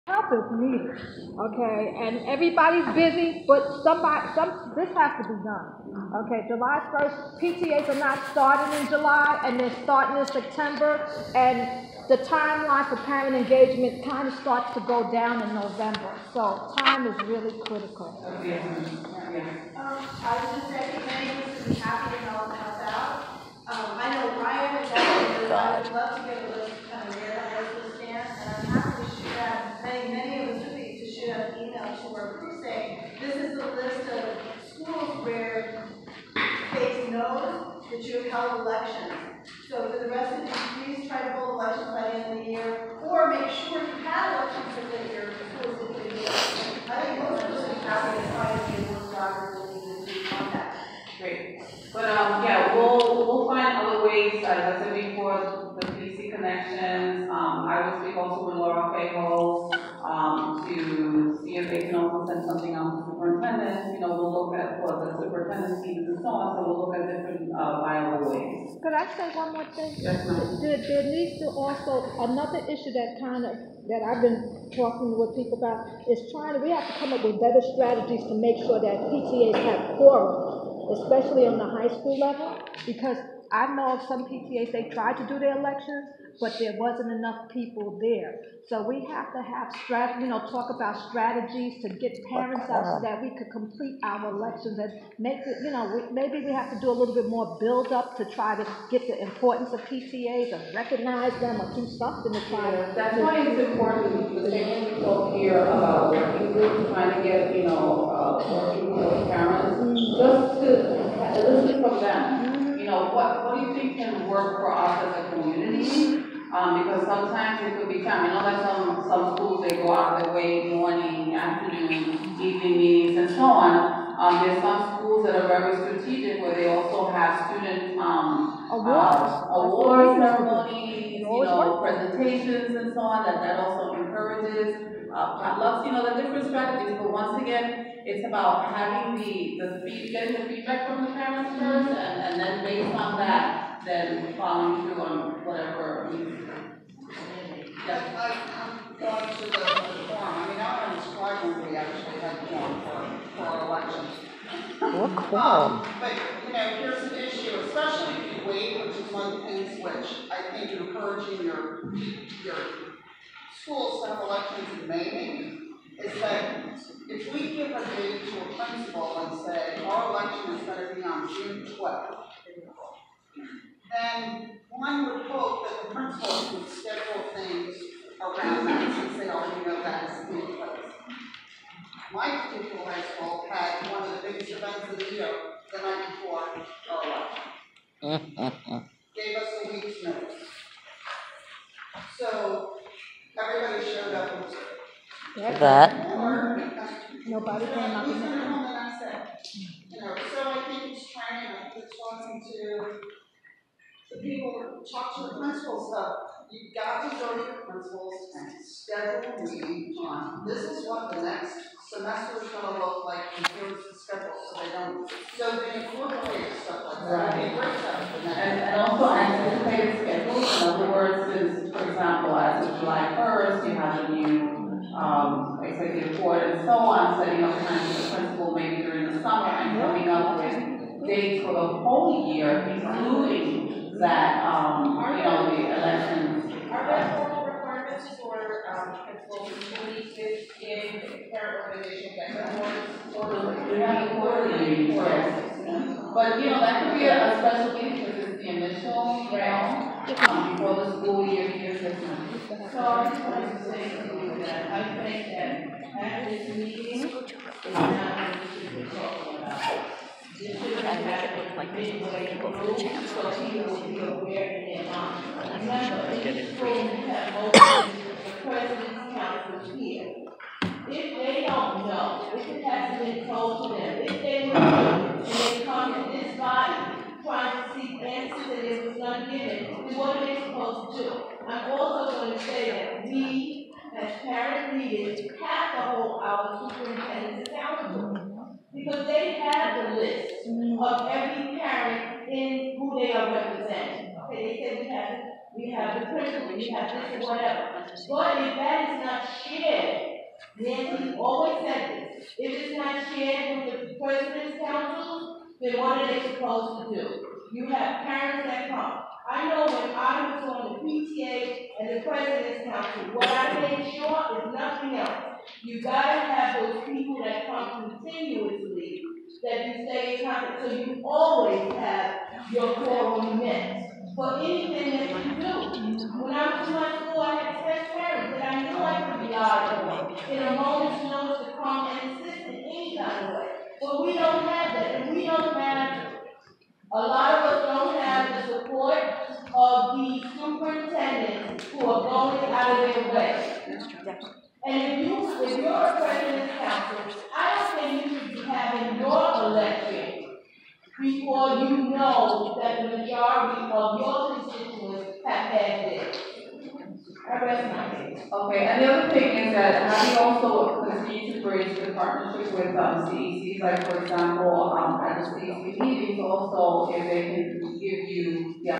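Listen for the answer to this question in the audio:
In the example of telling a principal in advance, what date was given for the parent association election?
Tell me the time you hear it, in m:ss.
2:51.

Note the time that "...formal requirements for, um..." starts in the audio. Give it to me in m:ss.
3:57.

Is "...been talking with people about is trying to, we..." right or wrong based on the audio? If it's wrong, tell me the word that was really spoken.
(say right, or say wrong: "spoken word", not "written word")
right.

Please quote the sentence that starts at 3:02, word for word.
My particular high school had one of the biggest events of the year the night before our election.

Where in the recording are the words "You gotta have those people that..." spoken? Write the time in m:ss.
5:15.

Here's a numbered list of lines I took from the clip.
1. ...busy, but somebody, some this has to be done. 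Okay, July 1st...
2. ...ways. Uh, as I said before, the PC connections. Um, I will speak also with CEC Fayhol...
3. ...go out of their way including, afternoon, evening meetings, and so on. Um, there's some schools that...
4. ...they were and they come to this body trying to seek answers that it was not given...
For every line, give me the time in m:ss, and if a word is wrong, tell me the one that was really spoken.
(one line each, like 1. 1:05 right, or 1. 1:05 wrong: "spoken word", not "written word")
1. 0:02 right
2. 0:54 wrong: "Laura", not "CEC"
3. 1:59 wrong: "morning", not "including"
4. 4:34 right.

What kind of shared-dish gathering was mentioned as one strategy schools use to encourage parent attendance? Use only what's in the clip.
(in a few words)
potlucks.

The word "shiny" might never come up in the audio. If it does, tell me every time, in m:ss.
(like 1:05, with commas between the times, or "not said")
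not said.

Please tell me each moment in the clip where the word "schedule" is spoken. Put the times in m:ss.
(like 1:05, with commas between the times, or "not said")
2:56, 3:28.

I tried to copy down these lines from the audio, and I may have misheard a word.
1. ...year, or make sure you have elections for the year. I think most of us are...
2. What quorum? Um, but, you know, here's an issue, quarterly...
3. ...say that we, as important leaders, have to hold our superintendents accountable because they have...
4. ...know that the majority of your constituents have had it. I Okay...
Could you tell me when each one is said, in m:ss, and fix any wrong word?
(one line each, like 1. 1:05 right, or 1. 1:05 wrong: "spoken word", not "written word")
1. 0:42 right
2. 2:34 wrong: "especially", not "quarterly"
3. 4:42 wrong: "parent", not "important"
4. 5:51 right.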